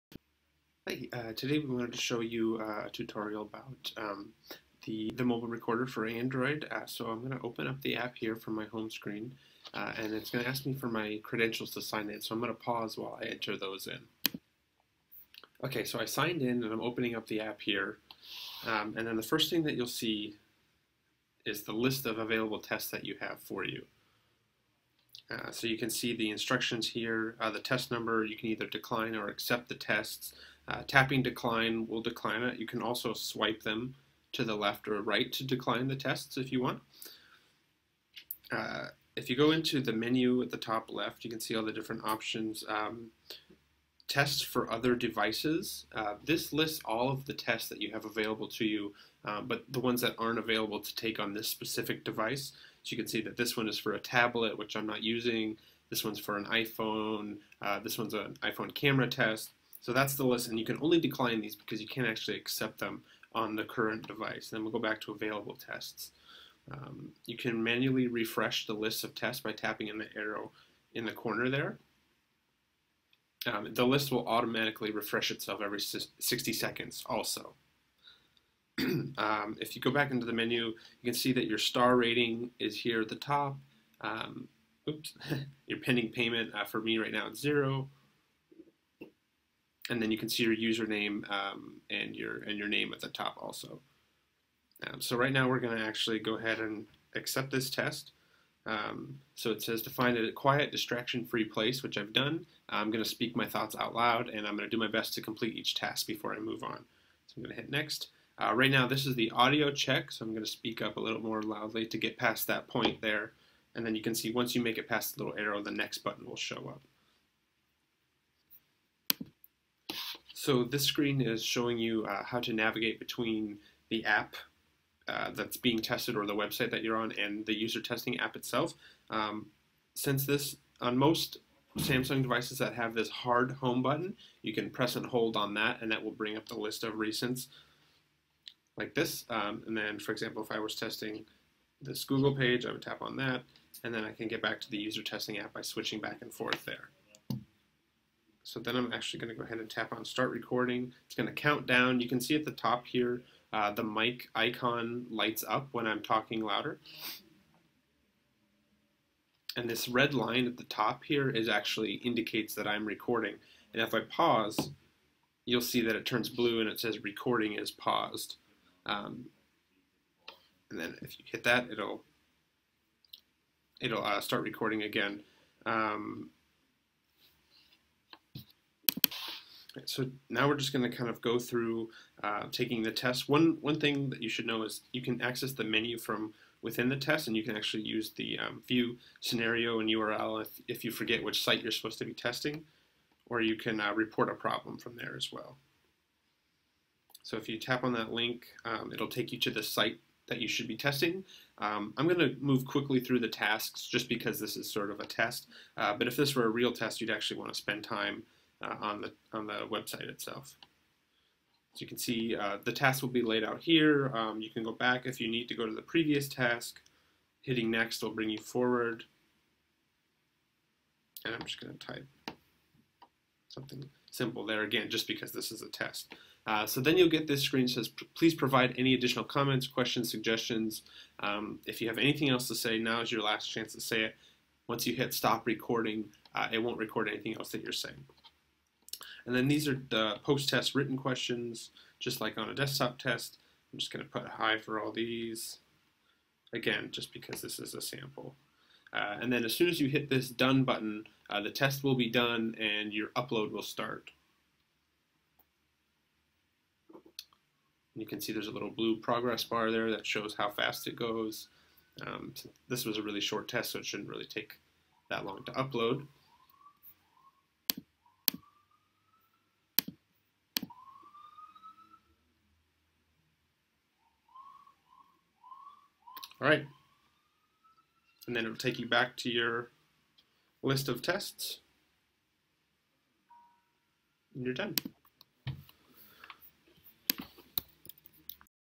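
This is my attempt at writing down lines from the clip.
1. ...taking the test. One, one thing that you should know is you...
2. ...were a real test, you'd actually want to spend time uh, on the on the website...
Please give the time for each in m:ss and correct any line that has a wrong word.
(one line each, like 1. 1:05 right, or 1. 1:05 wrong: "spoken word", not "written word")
1. 3:02 right
2. 3:26 right.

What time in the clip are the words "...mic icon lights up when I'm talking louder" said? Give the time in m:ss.
2:33.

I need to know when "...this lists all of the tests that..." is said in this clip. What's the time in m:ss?
0:46.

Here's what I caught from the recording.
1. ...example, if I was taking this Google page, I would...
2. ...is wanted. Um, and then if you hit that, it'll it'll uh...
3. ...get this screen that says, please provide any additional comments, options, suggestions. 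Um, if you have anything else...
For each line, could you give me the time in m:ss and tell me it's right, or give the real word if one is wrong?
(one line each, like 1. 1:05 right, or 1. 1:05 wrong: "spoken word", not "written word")
1. 2:20 wrong: "testing", not "taking"
2. 2:47 wrong: "paused", not "wanted"
3. 3:47 wrong: "questions", not "options".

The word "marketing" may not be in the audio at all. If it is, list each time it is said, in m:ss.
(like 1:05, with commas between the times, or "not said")
not said.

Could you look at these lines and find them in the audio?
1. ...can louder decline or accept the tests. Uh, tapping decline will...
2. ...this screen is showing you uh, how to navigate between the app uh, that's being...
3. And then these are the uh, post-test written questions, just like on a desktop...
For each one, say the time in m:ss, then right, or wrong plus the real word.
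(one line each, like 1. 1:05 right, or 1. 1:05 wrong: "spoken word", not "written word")
1. 0:28 wrong: "either", not "louder"
2. 2:00 right
3. 3:59 right.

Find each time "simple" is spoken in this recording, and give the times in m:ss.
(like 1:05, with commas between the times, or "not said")
3:44.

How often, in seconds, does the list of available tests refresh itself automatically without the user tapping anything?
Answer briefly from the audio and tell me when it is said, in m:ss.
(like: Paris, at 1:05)
60, at 1:15.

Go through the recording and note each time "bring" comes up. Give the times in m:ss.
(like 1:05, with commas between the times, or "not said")
2:16, 3:38.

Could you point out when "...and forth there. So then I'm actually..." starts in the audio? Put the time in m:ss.
2:26.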